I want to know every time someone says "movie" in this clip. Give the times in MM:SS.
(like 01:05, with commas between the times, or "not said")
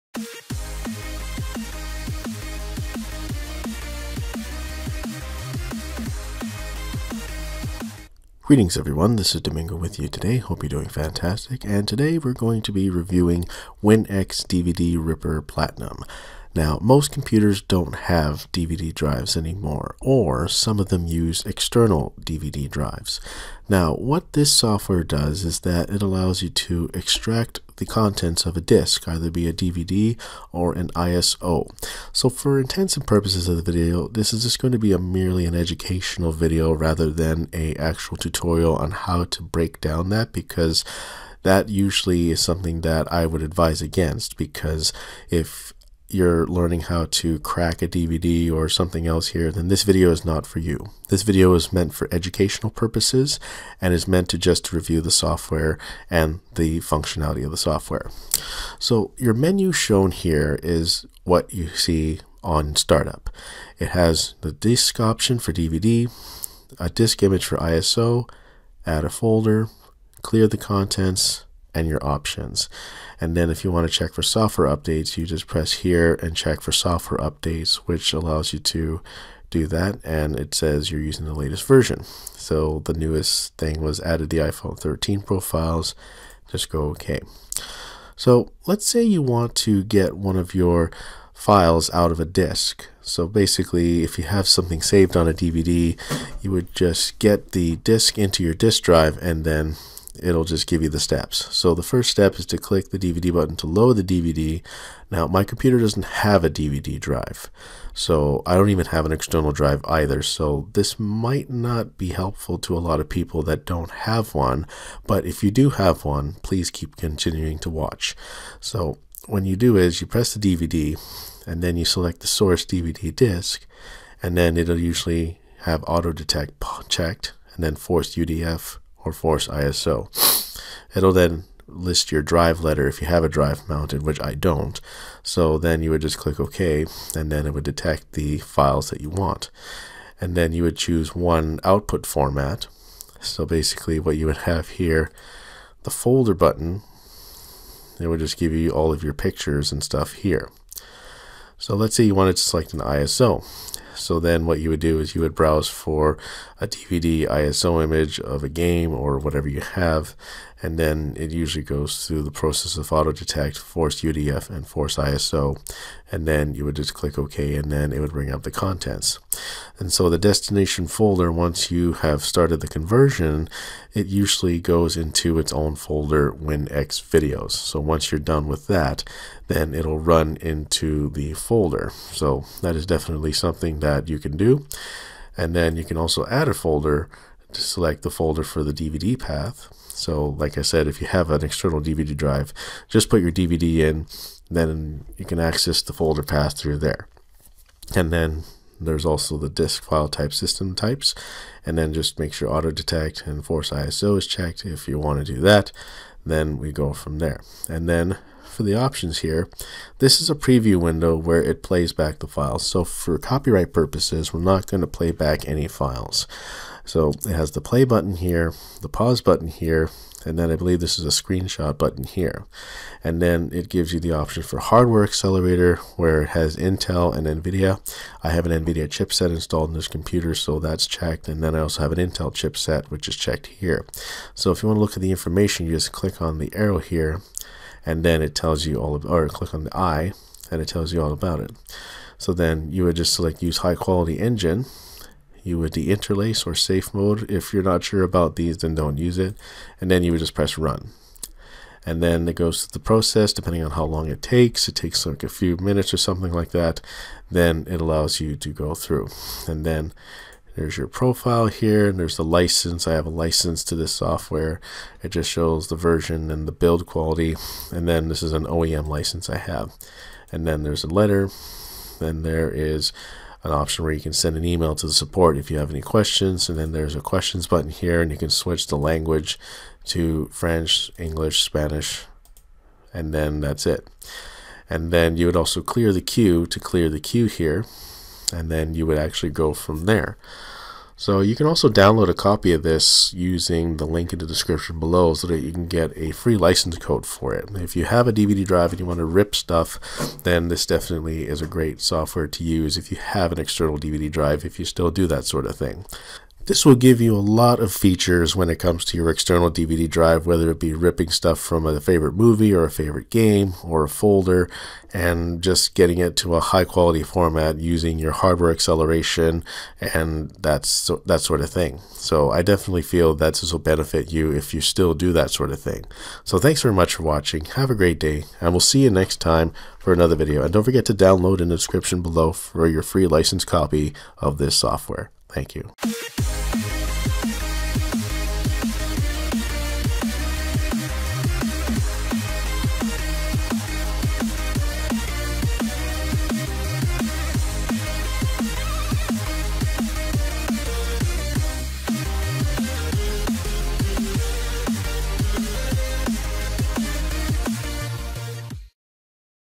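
05:12.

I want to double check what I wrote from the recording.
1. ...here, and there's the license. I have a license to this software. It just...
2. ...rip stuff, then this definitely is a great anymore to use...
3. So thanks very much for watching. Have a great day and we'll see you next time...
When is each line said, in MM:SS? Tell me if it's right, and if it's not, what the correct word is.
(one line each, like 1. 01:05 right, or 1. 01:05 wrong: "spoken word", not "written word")
1. 04:21 right
2. 04:59 wrong: "software", not "anymore"
3. 05:26 right.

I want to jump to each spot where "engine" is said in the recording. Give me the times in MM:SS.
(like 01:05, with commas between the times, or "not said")
04:04.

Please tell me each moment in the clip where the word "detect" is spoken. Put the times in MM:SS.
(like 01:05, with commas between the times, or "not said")
02:06, 02:17, 02:43, 03:22.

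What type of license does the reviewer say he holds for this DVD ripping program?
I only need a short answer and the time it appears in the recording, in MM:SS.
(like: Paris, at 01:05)
OEM license, at 04:28.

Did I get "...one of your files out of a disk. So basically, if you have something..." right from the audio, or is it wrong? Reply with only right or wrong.
right.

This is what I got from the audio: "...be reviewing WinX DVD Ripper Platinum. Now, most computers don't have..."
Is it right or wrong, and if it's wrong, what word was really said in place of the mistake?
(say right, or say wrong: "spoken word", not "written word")
right.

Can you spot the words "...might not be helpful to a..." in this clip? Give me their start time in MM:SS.
01:50.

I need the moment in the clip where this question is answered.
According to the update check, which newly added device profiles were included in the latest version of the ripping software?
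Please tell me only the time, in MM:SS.
01:24.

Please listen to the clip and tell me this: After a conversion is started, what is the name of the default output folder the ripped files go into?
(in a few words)
WinX Videos.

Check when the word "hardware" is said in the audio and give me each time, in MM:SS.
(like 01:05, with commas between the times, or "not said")
03:44, 05:18.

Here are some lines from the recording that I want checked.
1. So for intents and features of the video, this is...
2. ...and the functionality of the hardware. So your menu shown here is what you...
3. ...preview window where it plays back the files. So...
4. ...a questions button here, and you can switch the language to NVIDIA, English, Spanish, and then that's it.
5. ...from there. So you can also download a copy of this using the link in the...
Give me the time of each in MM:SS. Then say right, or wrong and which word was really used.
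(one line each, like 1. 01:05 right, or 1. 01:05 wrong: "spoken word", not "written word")
1. 00:32 wrong: "purposes", not "features"
2. 00:56 wrong: "software", not "hardware"
3. 03:30 right
4. 04:36 wrong: "French", not "NVIDIA"
5. 04:49 right.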